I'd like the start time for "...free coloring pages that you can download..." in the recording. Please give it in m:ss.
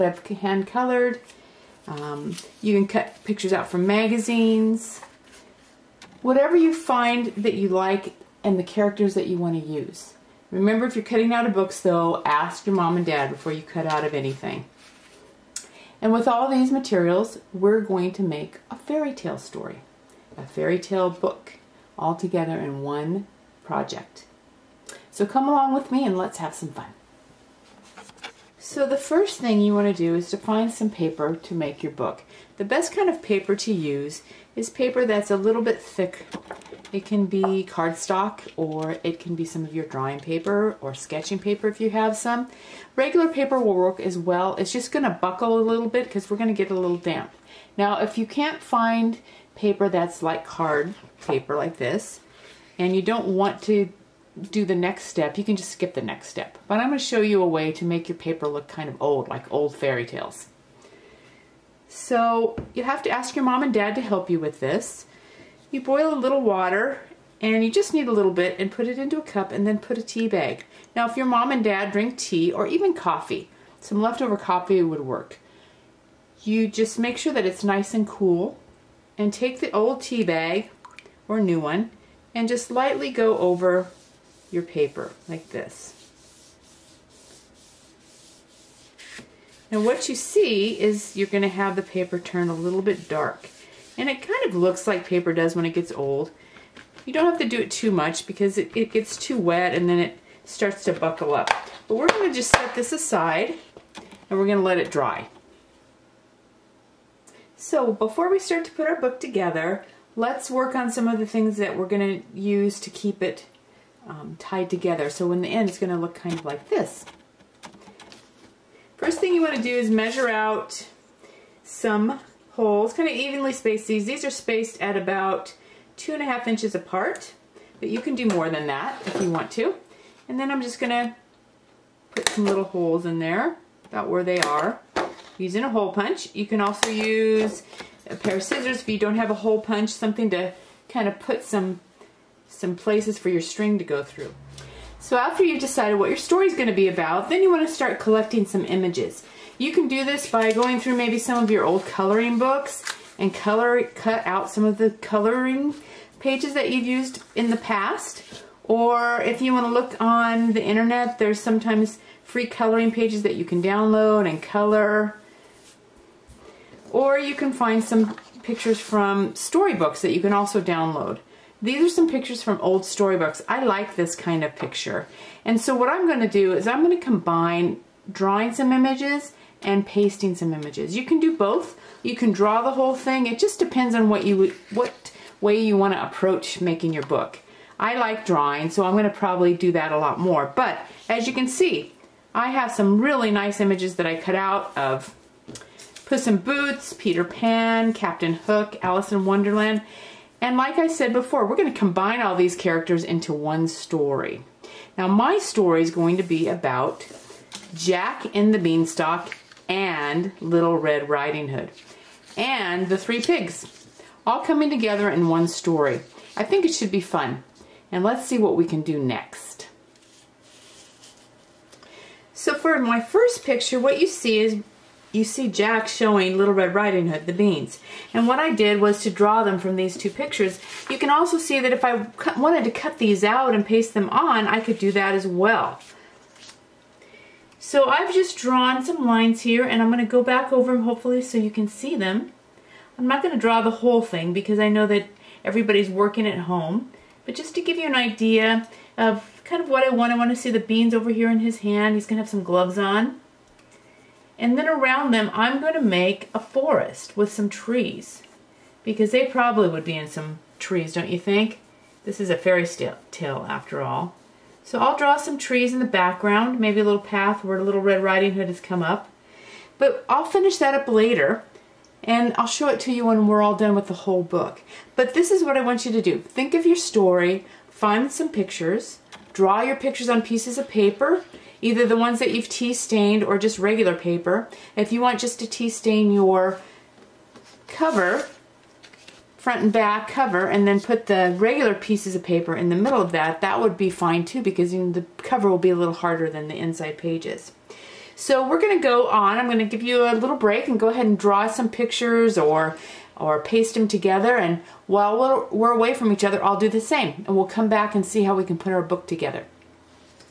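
2:42.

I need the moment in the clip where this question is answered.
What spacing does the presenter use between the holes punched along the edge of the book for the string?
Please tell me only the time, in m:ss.
2:05.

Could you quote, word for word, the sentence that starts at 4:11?
He's going to have some gloves on.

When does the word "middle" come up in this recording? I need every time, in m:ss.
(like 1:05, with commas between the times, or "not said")
4:52.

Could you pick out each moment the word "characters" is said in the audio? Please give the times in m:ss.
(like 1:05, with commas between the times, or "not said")
0:08, 3:22.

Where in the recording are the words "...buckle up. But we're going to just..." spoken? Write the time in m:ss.
1:40.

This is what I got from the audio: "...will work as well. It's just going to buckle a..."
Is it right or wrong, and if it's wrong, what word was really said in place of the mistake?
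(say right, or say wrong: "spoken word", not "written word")
right.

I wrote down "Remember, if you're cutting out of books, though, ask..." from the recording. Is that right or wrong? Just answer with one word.
right.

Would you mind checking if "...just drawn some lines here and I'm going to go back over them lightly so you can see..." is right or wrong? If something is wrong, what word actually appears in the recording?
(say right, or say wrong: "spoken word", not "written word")
wrong: "hopefully", not "lightly".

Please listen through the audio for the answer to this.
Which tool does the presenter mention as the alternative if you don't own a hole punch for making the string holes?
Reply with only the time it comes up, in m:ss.
2:18.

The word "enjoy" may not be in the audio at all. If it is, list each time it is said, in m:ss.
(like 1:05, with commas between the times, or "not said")
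not said.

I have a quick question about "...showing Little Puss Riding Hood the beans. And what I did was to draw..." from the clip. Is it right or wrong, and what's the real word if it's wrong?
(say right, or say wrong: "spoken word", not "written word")
wrong: "Red", not "Puss".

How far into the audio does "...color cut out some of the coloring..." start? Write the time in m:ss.
2:33.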